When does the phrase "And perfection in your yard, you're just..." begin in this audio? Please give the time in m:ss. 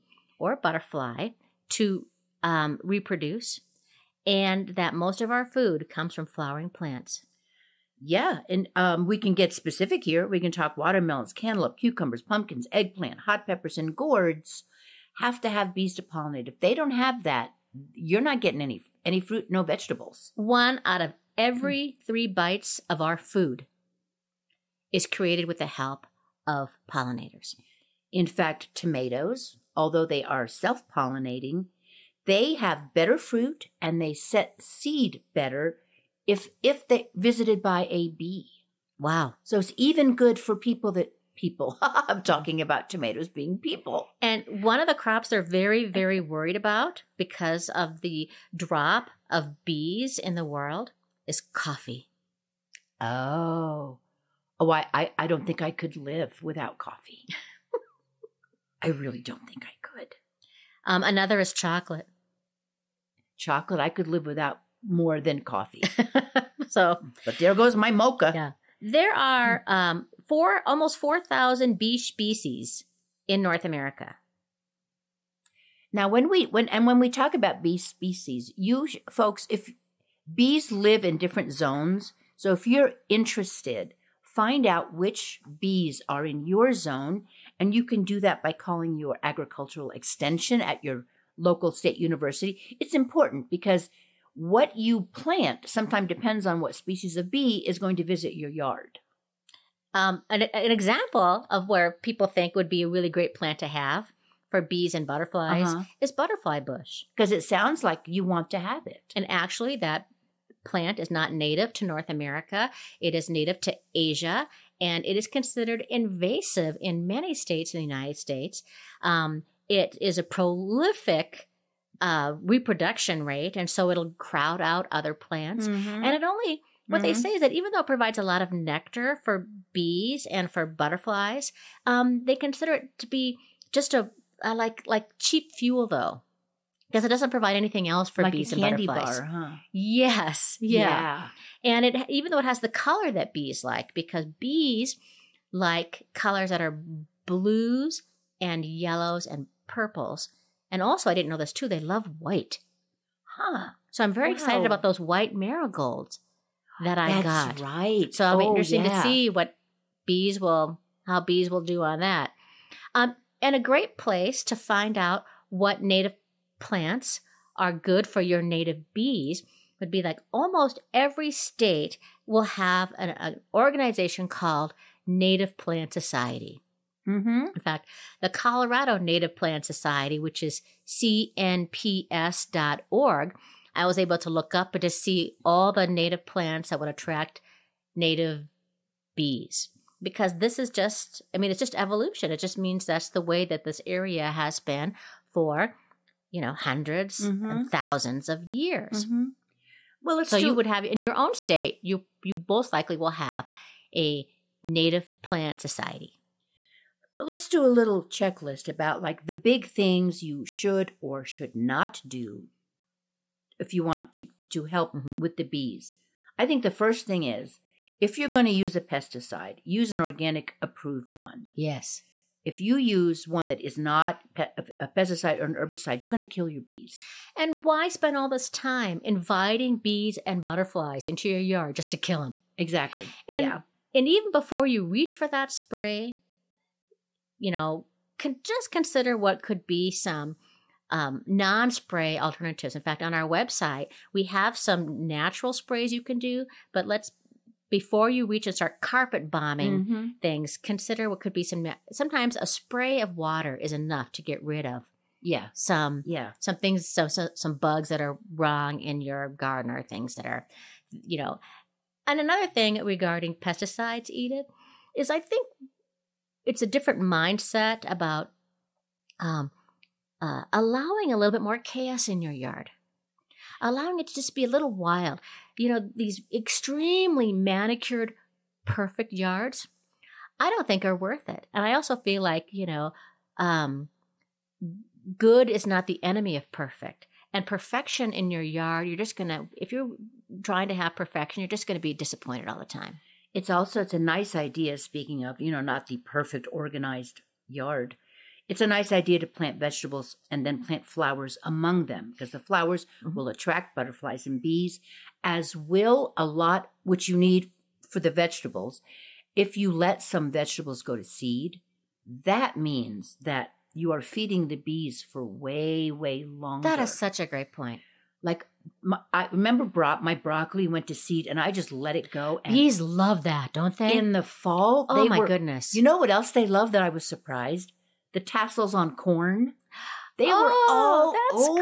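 4:47.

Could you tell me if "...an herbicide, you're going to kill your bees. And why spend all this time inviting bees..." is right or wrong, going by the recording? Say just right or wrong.
right.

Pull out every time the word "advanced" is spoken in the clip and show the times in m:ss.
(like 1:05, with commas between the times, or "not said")
not said.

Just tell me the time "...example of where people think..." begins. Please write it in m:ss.
1:40.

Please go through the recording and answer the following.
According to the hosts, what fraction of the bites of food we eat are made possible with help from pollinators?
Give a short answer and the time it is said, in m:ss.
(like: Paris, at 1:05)
1 out of 3, at 0:20.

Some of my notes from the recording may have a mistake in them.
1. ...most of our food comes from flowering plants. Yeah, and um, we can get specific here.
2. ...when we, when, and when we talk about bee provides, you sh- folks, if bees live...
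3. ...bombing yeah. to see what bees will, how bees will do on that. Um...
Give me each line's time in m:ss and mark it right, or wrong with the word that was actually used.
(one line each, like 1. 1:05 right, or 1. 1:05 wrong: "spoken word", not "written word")
1. 0:04 right
2. 1:16 wrong: "species", not "provides"
3. 2:38 wrong: "interesting", not "bombing".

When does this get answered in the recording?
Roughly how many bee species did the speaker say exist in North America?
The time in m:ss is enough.
1:10.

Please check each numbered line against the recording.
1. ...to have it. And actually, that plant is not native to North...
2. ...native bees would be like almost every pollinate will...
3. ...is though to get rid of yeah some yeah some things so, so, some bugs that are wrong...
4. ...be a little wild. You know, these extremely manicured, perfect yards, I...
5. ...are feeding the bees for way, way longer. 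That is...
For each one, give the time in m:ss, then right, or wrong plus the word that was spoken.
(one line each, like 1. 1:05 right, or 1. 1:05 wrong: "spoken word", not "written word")
1. 1:48 right
2. 2:48 wrong: "state", not "pollinate"
3. 4:13 wrong: "enough", not "though"
4. 4:34 right
5. 5:13 right.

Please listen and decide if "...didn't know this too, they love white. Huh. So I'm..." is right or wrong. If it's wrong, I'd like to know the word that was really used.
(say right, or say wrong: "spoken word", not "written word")
right.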